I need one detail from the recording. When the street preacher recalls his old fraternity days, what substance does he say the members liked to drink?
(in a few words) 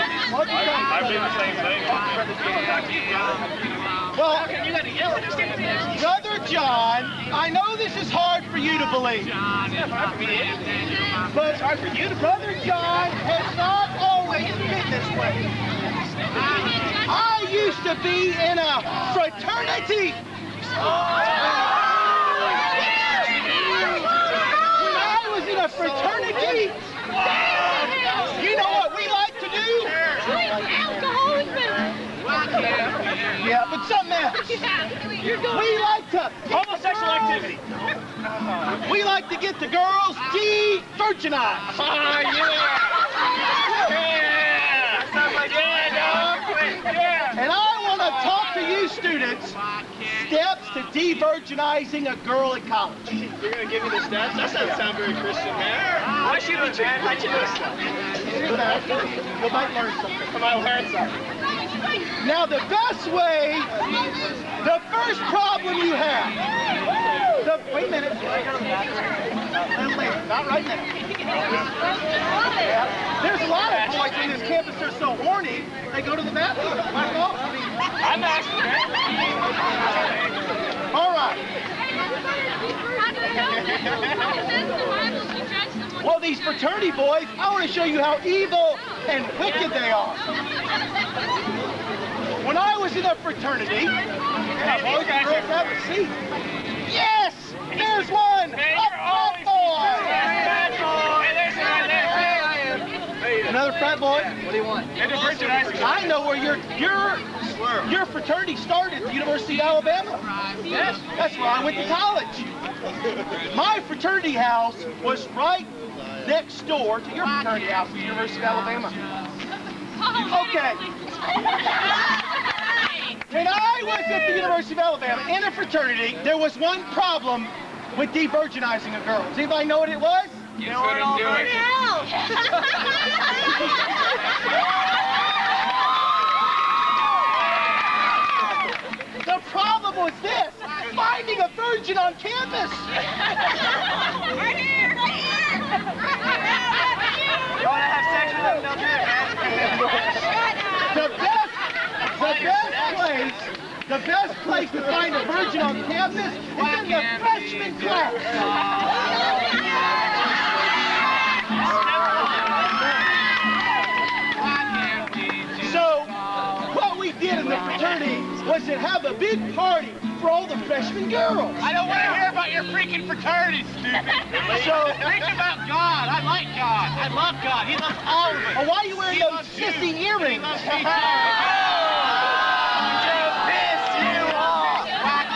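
alcohol.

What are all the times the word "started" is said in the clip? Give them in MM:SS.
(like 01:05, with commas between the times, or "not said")
01:48.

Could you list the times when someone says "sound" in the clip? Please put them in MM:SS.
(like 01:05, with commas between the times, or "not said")
00:54.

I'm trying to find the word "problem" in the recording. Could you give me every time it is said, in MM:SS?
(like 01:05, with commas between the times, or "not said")
01:05, 02:06, 02:19.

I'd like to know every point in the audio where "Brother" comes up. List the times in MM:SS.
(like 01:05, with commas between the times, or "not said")
00:05, 00:12.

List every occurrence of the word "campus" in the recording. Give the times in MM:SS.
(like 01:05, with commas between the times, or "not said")
01:14, 02:22, 02:35.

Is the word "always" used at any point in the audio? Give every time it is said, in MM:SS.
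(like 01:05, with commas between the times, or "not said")
00:13.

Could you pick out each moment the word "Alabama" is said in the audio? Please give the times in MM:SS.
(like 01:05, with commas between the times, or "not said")
01:49, 01:58, 02:04.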